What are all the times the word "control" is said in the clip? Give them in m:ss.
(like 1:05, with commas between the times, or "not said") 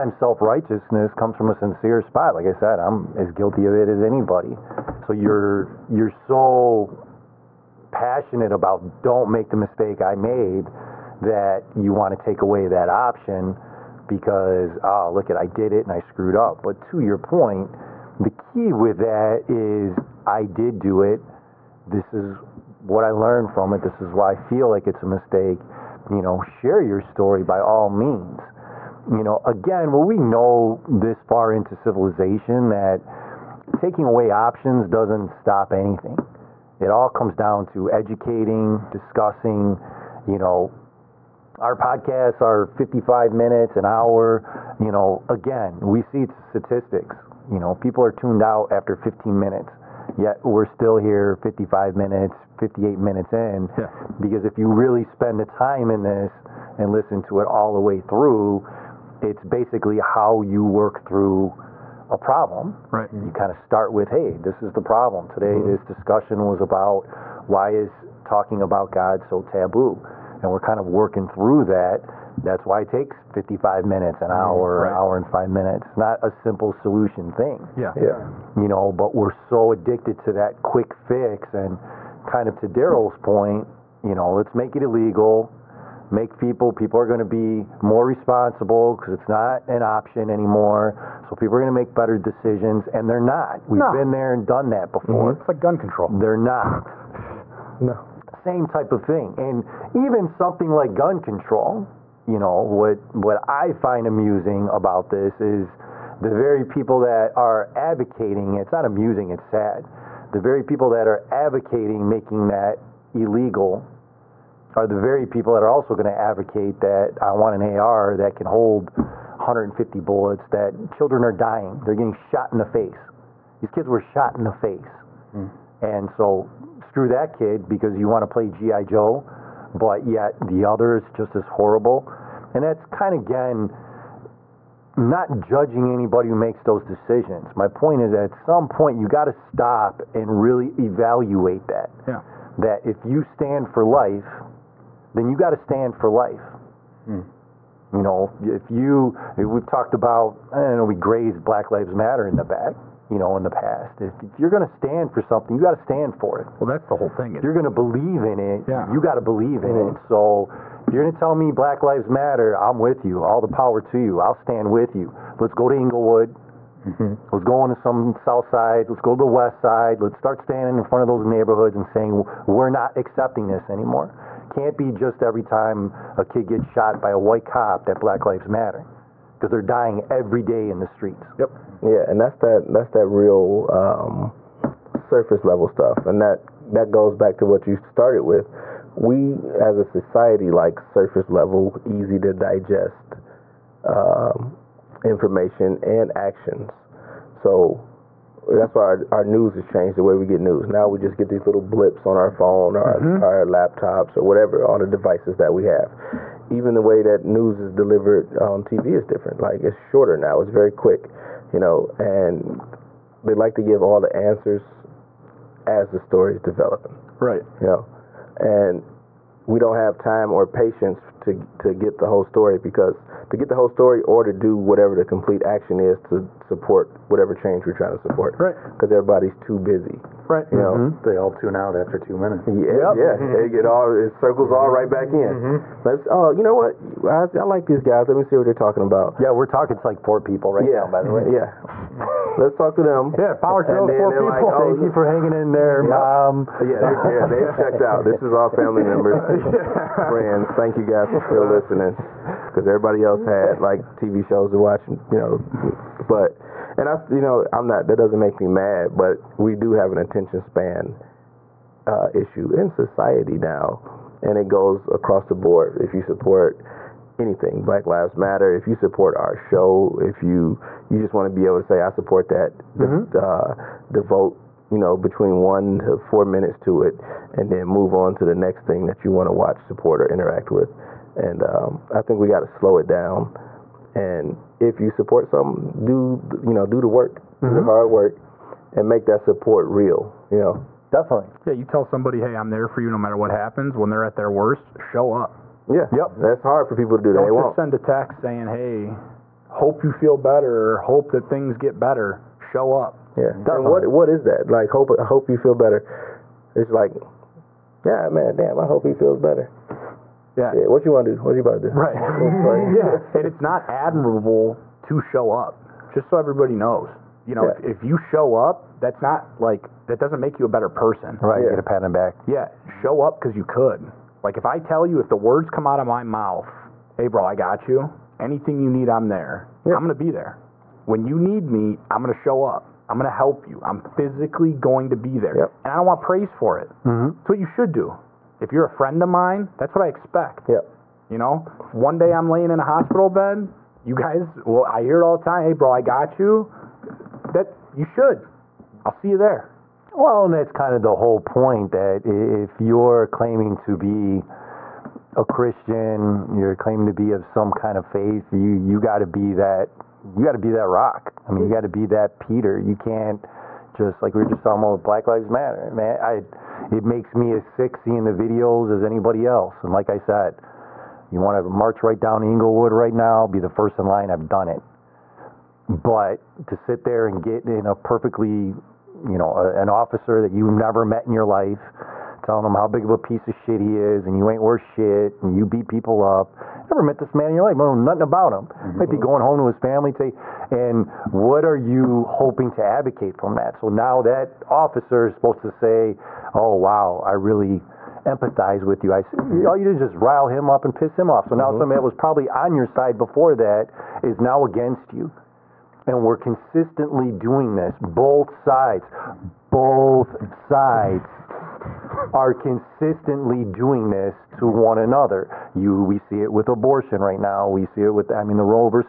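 1:35, 1:41.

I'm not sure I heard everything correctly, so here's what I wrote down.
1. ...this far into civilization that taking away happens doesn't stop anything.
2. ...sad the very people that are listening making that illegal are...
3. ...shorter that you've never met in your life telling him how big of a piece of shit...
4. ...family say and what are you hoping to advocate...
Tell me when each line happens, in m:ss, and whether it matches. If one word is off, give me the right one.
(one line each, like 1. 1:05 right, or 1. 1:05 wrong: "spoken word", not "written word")
1. 0:30 wrong: "options", not "happens"
2. 1:49 wrong: "advocating", not "listening"
3. 6:19 wrong: "officer", not "shorter"
4. 6:29 right.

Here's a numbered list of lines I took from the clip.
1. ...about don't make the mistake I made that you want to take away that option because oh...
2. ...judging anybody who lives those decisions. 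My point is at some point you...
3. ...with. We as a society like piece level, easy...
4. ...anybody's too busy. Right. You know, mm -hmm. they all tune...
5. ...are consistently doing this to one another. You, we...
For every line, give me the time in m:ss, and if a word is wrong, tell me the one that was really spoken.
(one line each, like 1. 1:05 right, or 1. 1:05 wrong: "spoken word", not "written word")
1. 0:08 right
2. 2:15 wrong: "makes", not "lives"
3. 3:08 wrong: "surface", not "piece"
4. 3:48 wrong: "everybody", not "anybody"
5. 6:52 right.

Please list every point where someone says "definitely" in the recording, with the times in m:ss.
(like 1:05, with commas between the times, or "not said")
4:50, 5:03.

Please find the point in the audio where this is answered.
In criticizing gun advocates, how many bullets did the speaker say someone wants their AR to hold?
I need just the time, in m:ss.
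1:58.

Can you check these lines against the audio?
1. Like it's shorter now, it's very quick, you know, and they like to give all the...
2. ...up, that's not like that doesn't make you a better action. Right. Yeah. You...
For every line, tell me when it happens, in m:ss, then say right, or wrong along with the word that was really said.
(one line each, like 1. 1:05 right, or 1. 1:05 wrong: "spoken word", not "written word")
1. 3:29 right
2. 5:18 wrong: "person", not "action".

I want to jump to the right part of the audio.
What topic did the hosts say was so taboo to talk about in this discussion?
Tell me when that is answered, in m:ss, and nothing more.
1:08.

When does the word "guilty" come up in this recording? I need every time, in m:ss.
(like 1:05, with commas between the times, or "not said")
0:03.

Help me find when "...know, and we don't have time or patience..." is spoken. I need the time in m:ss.
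3:37.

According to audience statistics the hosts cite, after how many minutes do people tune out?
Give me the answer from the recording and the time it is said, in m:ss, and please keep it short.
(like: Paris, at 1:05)
15 minutes, at 0:48.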